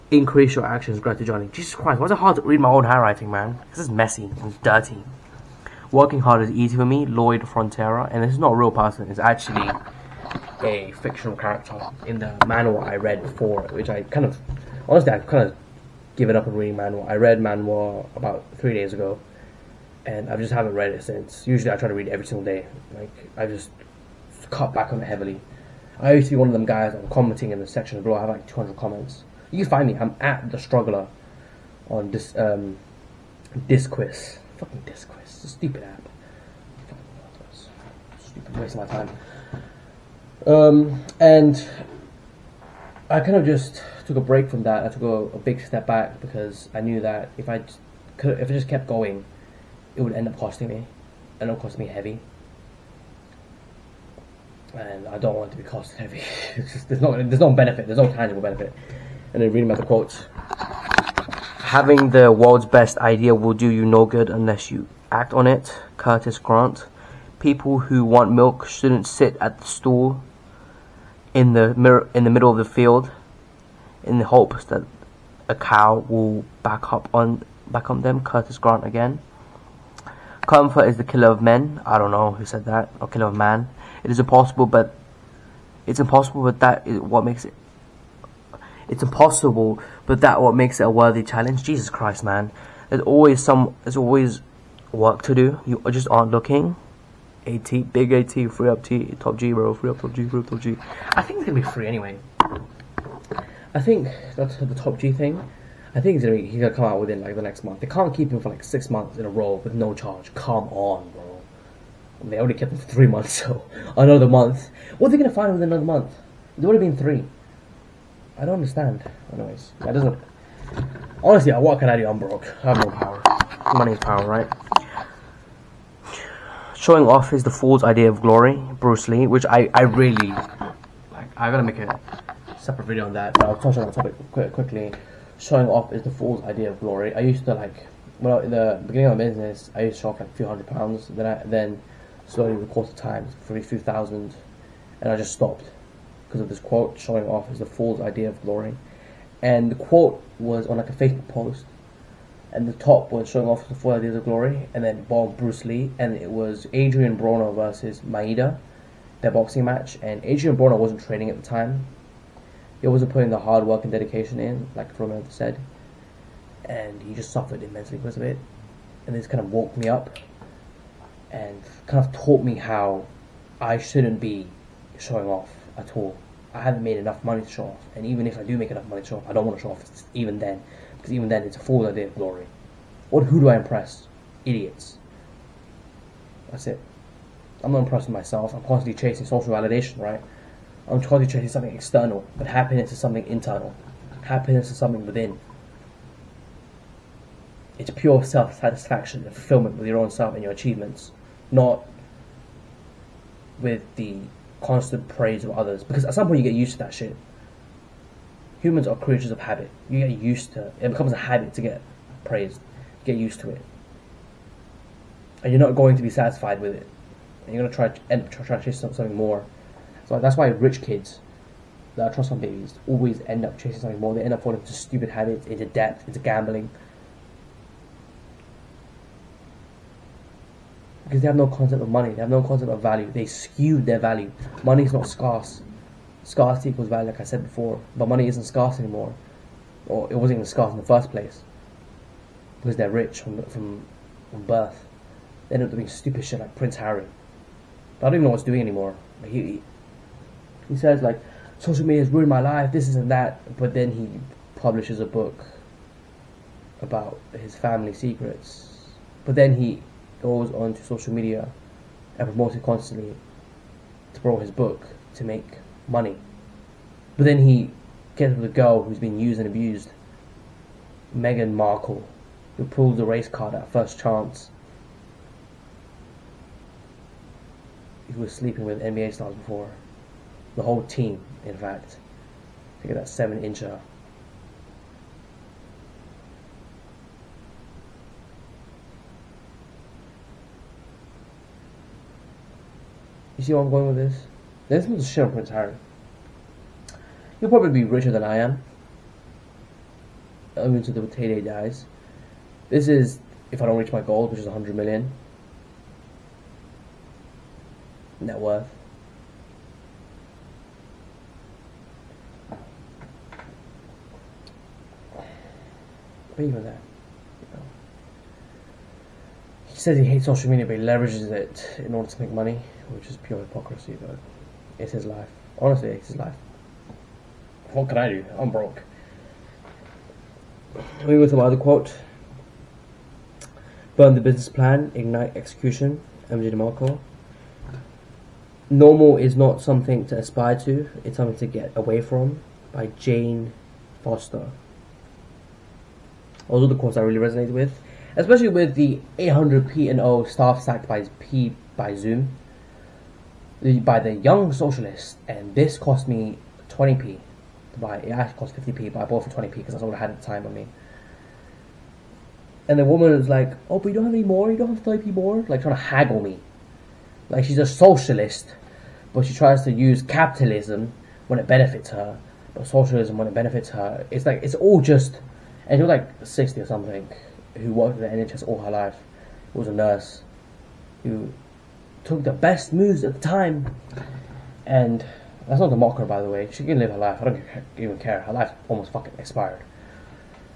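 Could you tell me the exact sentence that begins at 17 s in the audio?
I read manhwa about three days ago, and I just haven't read it since.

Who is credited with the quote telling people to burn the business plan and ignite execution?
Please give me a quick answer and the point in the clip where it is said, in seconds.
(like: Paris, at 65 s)
MJ DeMarco, at 336 s.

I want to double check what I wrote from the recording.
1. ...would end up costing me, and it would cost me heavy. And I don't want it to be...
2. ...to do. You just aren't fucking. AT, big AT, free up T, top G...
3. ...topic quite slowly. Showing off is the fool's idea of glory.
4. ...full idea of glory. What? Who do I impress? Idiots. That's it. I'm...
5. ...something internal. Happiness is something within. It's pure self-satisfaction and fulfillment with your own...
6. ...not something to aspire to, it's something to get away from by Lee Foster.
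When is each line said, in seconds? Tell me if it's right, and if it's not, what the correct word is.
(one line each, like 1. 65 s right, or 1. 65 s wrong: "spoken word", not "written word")
1. 50 s right
2. 95 s wrong: "looking", not "fucking"
3. 133 s wrong: "quickly", not "slowly"
4. 181 s right
5. 192 s right
6. 339 s wrong: "Jane", not "Lee".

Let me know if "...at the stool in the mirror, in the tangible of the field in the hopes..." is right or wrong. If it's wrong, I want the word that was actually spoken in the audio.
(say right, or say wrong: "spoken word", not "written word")
wrong: "middle", not "tangible".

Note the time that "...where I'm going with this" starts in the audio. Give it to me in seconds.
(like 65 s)
293 s.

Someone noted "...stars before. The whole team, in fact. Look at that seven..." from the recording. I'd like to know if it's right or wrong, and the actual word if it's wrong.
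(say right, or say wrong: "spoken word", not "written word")
right.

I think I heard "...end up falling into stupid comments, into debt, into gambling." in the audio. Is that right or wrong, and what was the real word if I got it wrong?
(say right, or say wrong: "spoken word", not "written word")
wrong: "habits", not "comments".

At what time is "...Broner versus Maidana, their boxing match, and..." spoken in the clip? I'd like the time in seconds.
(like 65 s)
157 s.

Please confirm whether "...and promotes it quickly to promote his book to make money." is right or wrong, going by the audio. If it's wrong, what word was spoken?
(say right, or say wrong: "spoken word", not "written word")
wrong: "constantly", not "quickly".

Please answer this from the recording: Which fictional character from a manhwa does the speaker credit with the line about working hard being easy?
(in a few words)
Lloyd Frontera.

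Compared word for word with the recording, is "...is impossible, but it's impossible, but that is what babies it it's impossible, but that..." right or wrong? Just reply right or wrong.
wrong.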